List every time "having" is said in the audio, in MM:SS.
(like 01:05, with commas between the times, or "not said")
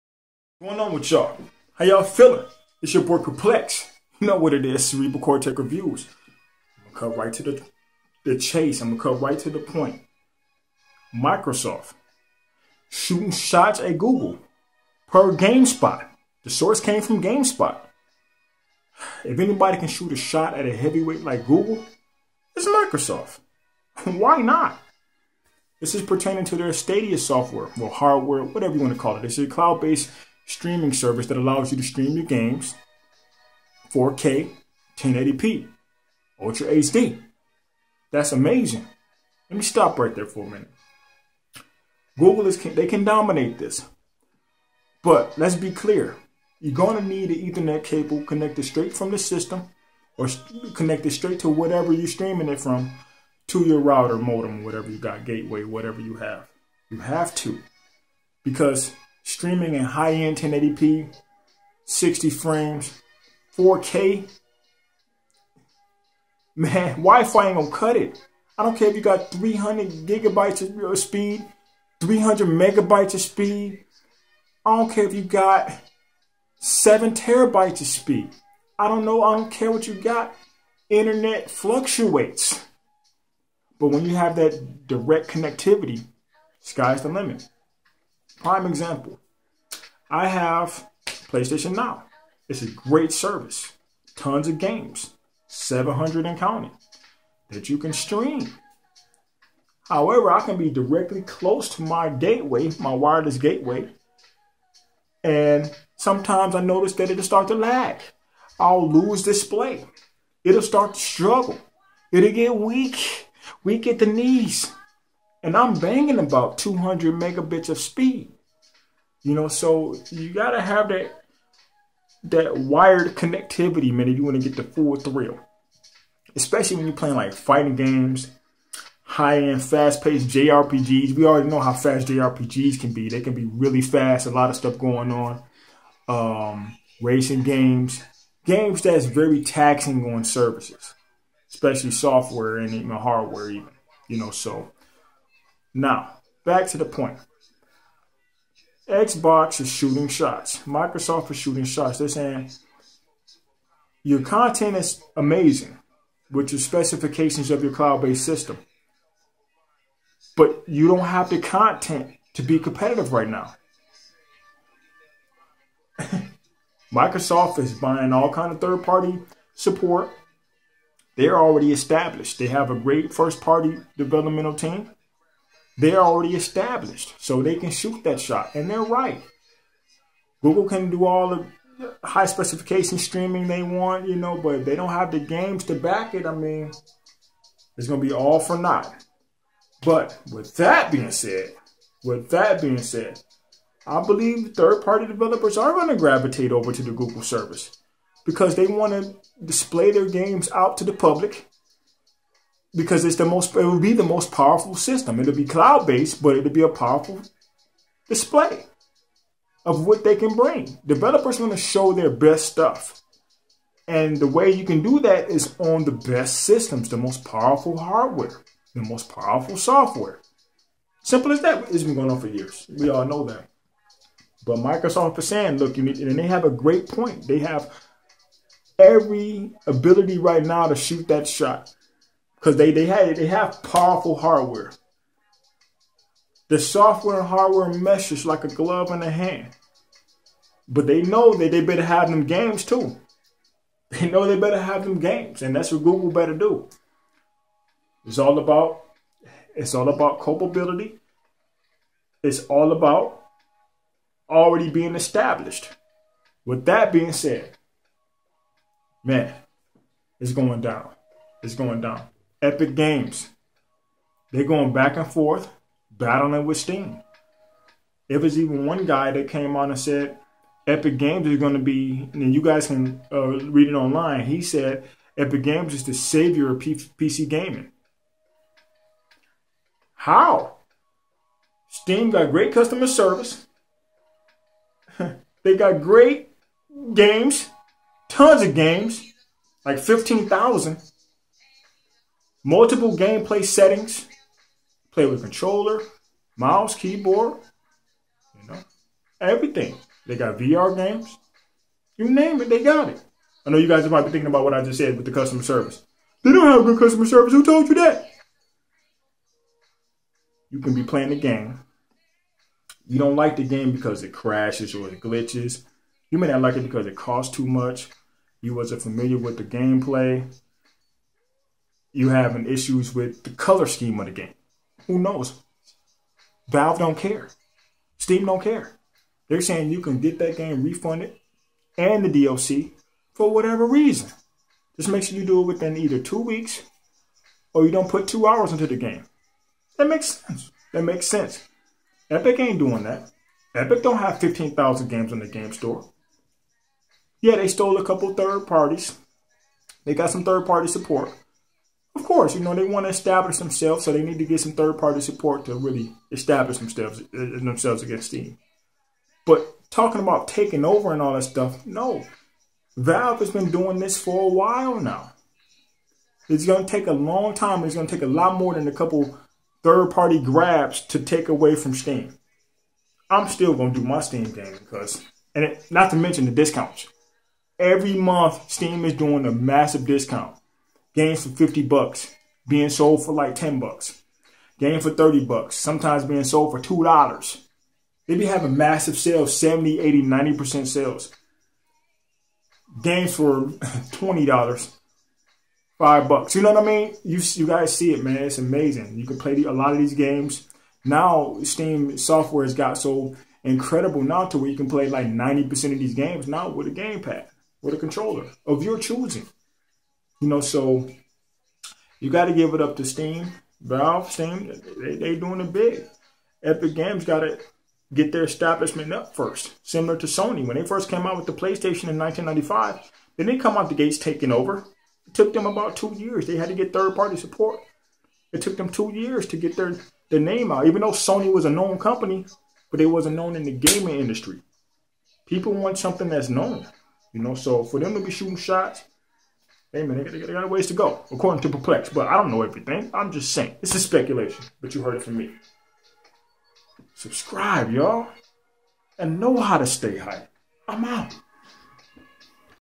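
05:22, 06:28.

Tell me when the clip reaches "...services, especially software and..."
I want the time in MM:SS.
02:20.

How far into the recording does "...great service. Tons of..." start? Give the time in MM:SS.
01:32.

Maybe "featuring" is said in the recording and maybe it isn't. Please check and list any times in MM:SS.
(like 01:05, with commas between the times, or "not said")
not said.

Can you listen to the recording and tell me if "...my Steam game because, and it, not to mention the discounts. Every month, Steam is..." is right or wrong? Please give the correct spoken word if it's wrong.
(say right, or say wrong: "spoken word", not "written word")
right.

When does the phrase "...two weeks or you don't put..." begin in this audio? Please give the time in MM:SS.
05:35.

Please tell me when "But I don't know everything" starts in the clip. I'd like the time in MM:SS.
07:21.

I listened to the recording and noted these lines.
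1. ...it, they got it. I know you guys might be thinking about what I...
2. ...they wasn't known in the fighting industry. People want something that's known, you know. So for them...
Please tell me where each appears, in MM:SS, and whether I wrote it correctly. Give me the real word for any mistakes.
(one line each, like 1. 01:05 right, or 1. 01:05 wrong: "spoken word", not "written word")
1. 05:02 right
2. 07:12 wrong: "gaming", not "fighting".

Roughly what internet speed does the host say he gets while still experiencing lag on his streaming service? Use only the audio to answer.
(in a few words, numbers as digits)
200 megabits.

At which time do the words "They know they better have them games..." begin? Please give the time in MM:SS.
04:03.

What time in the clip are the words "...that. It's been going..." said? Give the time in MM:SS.
03:41.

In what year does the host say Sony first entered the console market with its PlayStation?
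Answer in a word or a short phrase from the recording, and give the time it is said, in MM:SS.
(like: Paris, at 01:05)
1995, at 07:01.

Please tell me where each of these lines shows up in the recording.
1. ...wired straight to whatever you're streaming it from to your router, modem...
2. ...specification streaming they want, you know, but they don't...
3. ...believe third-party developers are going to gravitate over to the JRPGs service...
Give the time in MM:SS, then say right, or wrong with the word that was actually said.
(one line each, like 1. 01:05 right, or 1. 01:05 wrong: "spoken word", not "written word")
1. 00:50 wrong: "connected", not "wired"
2. 03:02 right
3. 03:14 wrong: "Google", not "JRPGs".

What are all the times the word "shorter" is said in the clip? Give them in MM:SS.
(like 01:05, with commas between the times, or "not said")
not said.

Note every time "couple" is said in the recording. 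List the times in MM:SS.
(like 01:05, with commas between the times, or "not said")
05:47, 06:08.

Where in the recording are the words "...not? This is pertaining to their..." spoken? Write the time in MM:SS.
00:24.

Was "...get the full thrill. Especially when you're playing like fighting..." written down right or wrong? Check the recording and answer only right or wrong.
right.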